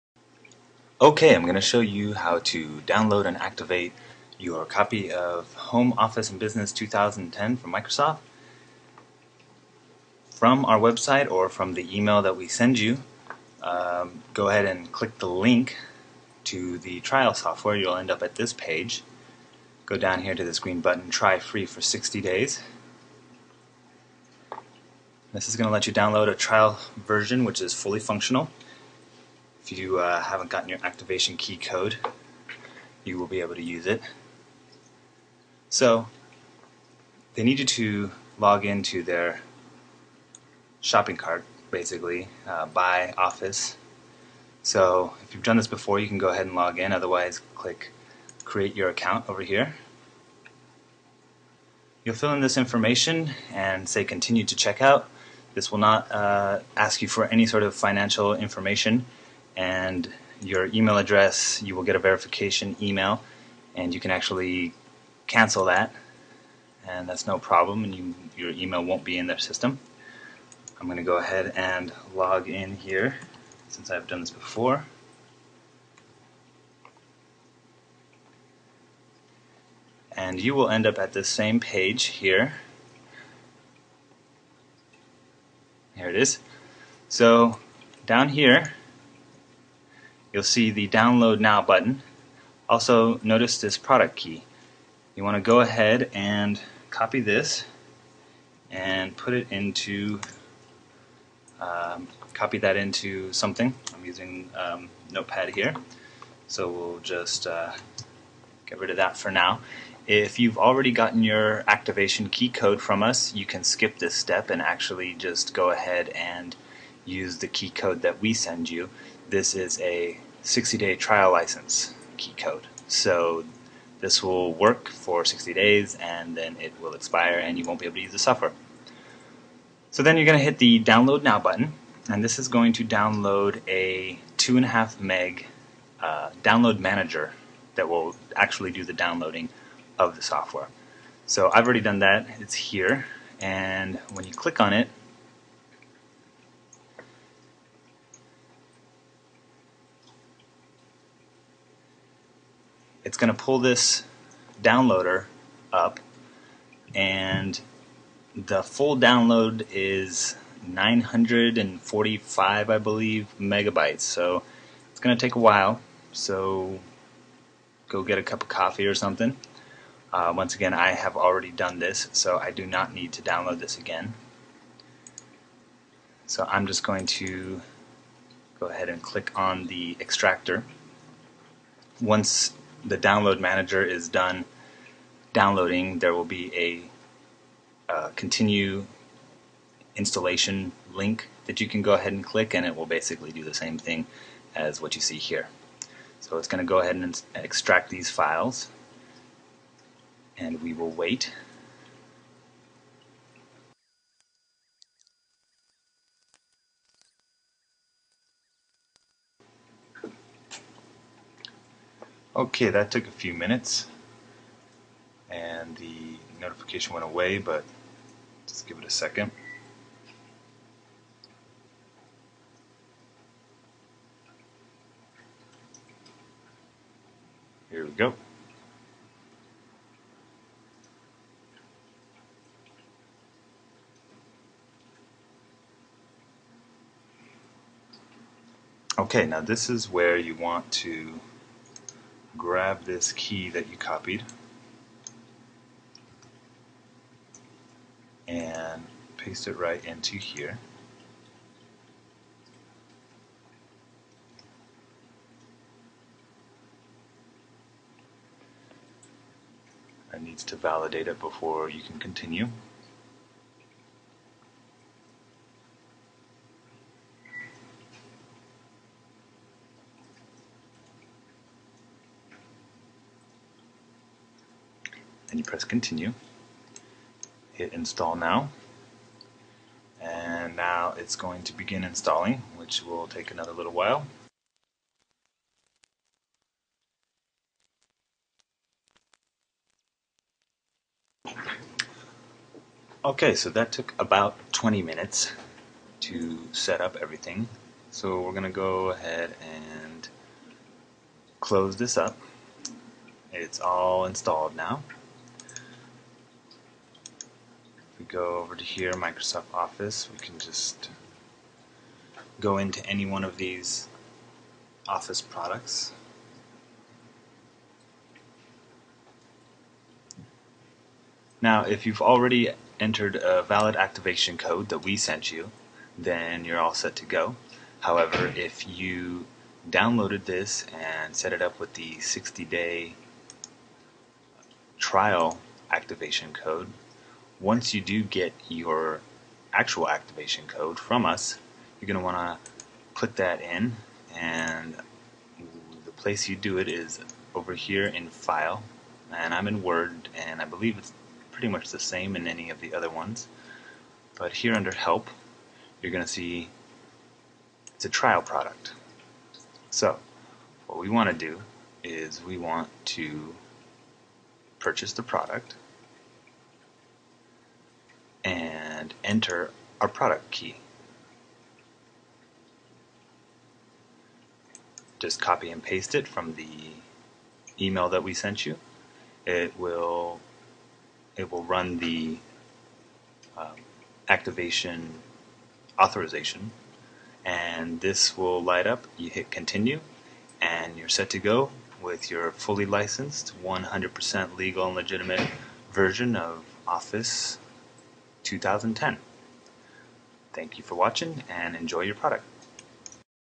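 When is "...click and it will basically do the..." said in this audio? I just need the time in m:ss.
3:12.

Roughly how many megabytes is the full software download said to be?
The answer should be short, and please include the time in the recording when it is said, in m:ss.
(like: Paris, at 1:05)
945, at 2:40.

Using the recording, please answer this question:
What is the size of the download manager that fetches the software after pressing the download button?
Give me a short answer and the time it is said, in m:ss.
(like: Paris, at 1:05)
2.5 meg, at 2:14.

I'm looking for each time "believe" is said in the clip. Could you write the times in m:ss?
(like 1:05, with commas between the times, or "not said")
2:42, 5:50.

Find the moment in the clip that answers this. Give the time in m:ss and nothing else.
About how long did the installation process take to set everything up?
4:54.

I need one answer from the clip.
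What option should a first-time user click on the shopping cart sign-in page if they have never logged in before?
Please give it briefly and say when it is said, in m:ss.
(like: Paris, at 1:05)
Create Your Account, at 0:48.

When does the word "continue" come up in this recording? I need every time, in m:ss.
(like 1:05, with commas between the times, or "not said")
0:54, 3:08, 4:21, 4:35, 6:29.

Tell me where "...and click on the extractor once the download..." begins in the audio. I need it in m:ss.
2:58.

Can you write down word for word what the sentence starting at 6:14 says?
Just copy and paste it from the email that we sent you.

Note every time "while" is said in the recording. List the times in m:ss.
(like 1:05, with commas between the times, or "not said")
2:45, 4:43.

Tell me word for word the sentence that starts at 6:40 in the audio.
Thank you for watching and enjoy your product.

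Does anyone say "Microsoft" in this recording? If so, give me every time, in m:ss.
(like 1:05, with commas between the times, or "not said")
0:07, 5:08.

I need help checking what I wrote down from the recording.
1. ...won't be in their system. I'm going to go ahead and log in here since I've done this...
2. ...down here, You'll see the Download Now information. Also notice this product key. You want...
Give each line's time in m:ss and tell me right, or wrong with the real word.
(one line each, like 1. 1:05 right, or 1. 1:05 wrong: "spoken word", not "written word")
1. 1:08 right
2. 1:28 wrong: "button", not "information".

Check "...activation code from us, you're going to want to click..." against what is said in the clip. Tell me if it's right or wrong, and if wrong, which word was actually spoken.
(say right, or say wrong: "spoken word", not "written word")
right.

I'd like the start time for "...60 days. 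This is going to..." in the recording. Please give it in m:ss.
0:21.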